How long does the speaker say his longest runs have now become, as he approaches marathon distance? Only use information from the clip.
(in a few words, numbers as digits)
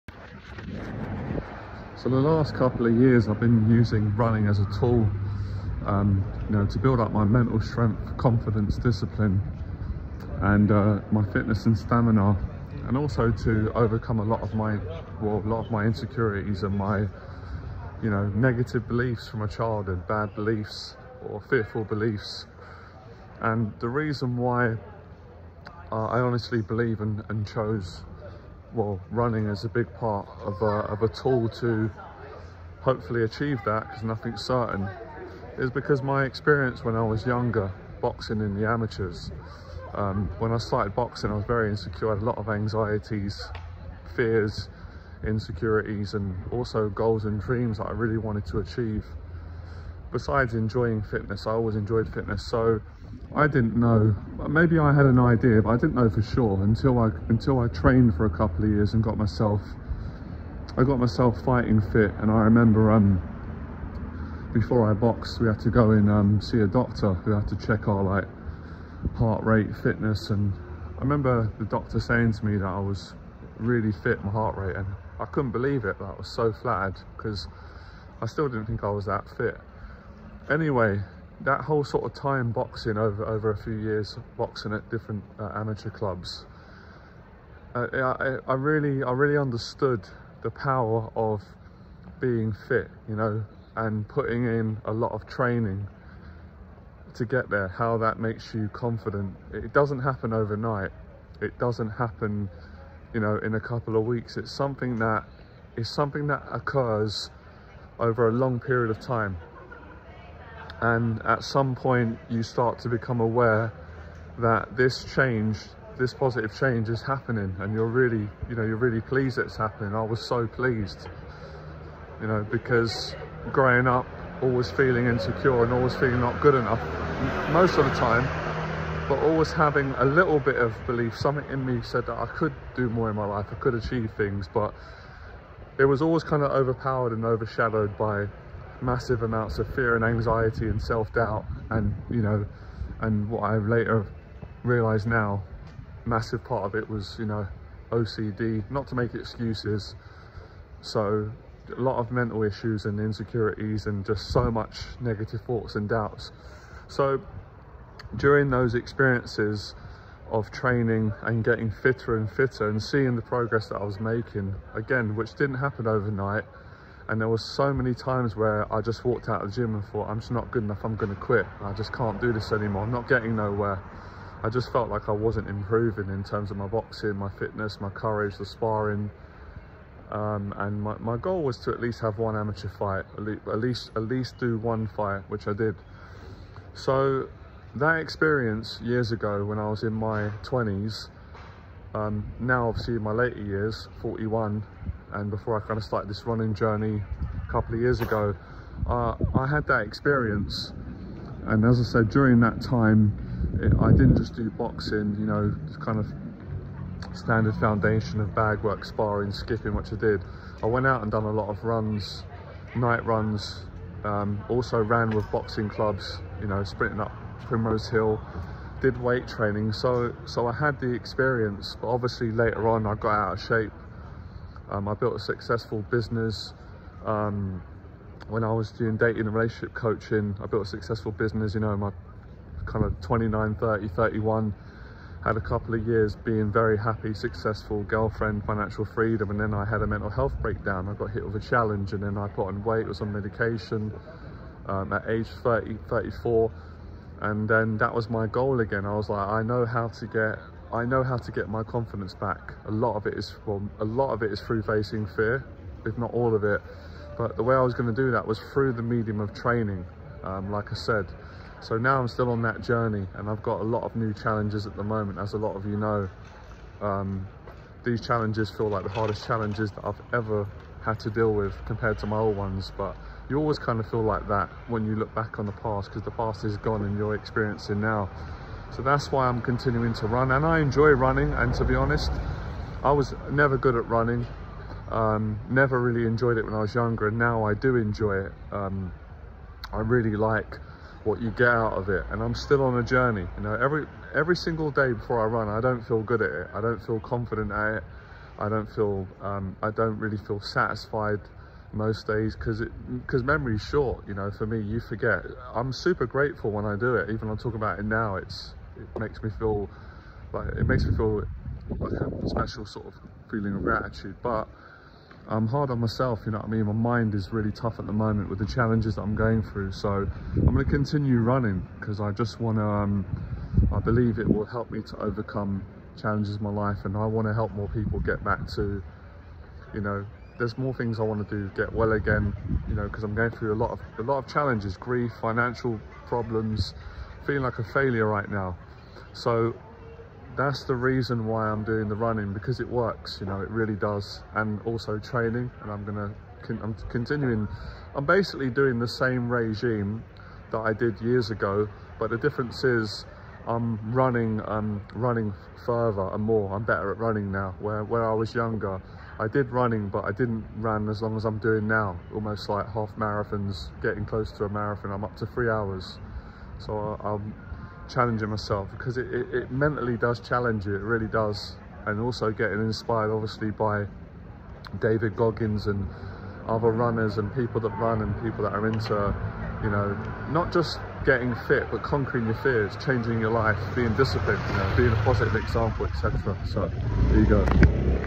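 3 hours.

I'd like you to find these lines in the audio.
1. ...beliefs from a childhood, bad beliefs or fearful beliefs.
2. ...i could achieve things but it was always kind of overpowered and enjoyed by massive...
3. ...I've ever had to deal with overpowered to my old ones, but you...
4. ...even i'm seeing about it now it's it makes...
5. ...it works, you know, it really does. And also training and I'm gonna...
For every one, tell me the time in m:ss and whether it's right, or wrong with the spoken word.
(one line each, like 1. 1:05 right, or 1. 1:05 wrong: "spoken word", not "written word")
1. 0:18 right
2. 2:13 wrong: "overshadowed", not "enjoyed"
3. 4:29 wrong: "compared", not "overpowered"
4. 5:07 wrong: "talking", not "seeing"
5. 5:42 right.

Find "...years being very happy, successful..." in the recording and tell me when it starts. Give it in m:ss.
3:55.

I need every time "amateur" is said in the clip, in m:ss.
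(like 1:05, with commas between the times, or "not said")
0:38, 1:25, 3:02.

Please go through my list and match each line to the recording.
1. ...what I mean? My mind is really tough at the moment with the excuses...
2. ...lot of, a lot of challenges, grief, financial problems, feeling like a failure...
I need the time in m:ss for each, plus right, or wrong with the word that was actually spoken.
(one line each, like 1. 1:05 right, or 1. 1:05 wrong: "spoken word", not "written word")
1. 5:16 wrong: "challenges", not "excuses"
2. 5:33 right.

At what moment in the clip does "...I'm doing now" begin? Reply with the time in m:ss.
6:01.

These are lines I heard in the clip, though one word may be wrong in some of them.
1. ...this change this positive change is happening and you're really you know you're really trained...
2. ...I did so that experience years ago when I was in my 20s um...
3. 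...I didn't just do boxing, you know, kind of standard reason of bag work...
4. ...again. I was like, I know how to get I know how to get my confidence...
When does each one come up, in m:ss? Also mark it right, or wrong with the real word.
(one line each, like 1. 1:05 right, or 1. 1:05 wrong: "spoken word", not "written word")
1. 1:54 wrong: "pleased", not "trained"
2. 3:05 right
3. 3:23 wrong: "foundation", not "reason"
4. 4:08 right.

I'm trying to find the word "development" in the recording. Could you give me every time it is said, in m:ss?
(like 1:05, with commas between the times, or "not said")
not said.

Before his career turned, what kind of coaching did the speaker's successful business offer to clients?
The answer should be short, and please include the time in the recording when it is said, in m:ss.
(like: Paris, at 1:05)
Dating and relationship coaching, at 3:48.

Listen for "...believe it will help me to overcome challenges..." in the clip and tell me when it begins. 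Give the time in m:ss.
5:23.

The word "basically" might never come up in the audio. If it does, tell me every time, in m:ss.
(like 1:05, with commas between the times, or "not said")
5:48.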